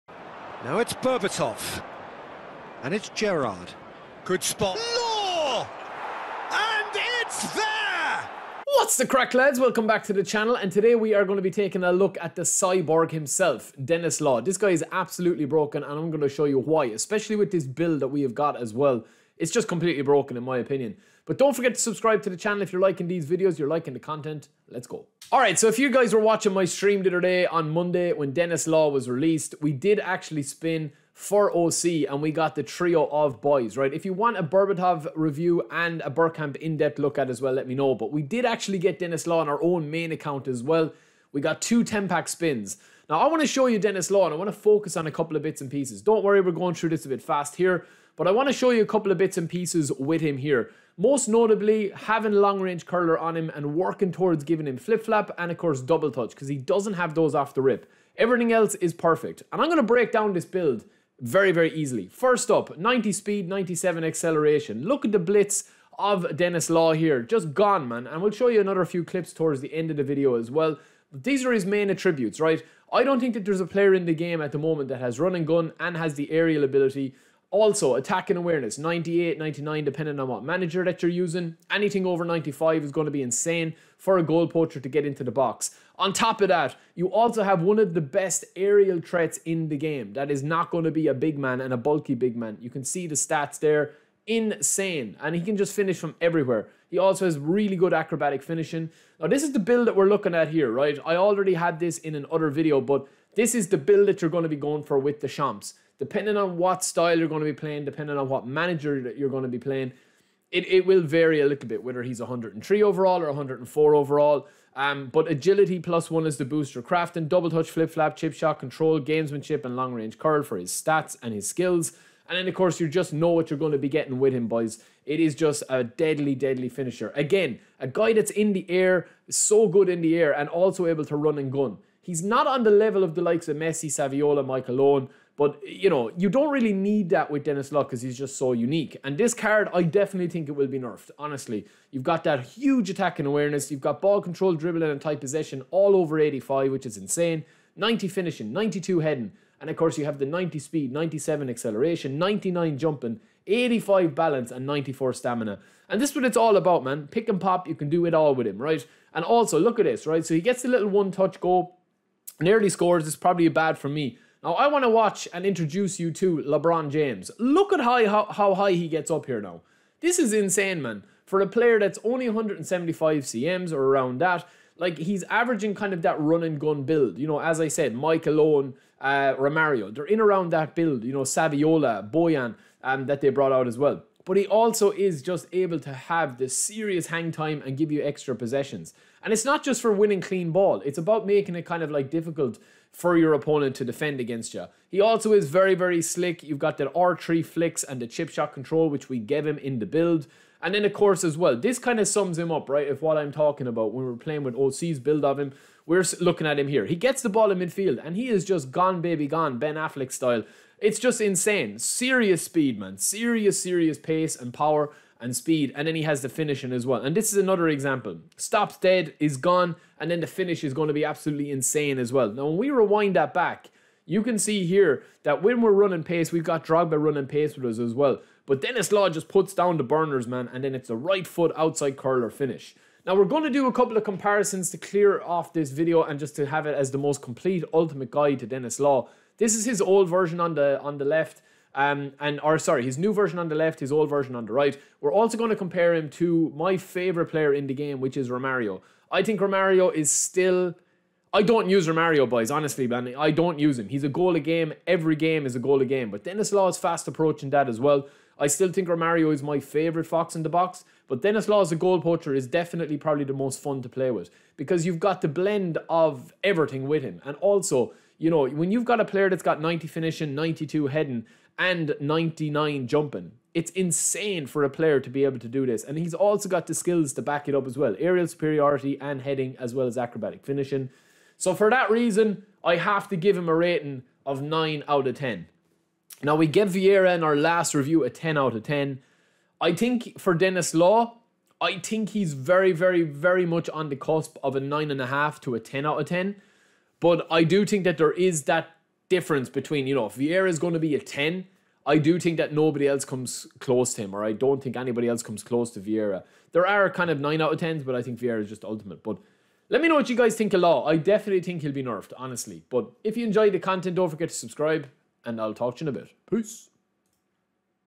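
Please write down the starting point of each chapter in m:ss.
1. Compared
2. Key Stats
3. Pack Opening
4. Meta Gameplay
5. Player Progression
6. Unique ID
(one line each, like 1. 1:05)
1. 3:50
2. 0:39
3. 0:25
4. 0:58
5. 1:38
6. 2:30.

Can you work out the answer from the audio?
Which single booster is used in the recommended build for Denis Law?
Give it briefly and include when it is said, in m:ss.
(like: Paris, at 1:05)
Agility plus one, at 1:55.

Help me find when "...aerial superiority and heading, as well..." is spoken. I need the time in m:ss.
4:37.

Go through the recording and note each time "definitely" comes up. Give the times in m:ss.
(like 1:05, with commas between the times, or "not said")
2:19, 4:22, 5:10.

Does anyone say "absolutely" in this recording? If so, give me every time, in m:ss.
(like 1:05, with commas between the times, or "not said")
0:14, 3:41.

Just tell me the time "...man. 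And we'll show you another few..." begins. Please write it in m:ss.
1:07.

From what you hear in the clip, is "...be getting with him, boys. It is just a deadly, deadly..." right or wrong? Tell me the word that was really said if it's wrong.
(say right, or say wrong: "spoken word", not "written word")
right.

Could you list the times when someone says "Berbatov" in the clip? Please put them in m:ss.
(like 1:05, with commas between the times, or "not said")
0:00, 0:34.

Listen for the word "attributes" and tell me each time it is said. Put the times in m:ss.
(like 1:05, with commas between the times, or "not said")
1:11.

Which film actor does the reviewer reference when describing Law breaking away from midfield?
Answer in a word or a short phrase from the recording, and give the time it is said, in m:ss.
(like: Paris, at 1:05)
Ben Affleck, at 3:29.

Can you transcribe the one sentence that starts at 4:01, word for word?
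Um, and or sorry, his new version on the left, his old version on the right.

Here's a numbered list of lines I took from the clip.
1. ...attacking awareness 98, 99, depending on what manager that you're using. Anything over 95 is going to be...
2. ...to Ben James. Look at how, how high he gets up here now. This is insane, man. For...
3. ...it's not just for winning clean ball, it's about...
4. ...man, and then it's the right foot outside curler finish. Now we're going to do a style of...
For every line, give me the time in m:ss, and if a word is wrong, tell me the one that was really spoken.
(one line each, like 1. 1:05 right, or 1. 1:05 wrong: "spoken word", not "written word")
1. 1:17 right
2. 2:46 wrong: "LeBron", not "Ben"
3. 3:09 right
4. 3:50 wrong: "couple", not "style".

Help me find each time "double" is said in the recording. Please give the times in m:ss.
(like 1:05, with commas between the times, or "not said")
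0:55, 1:57.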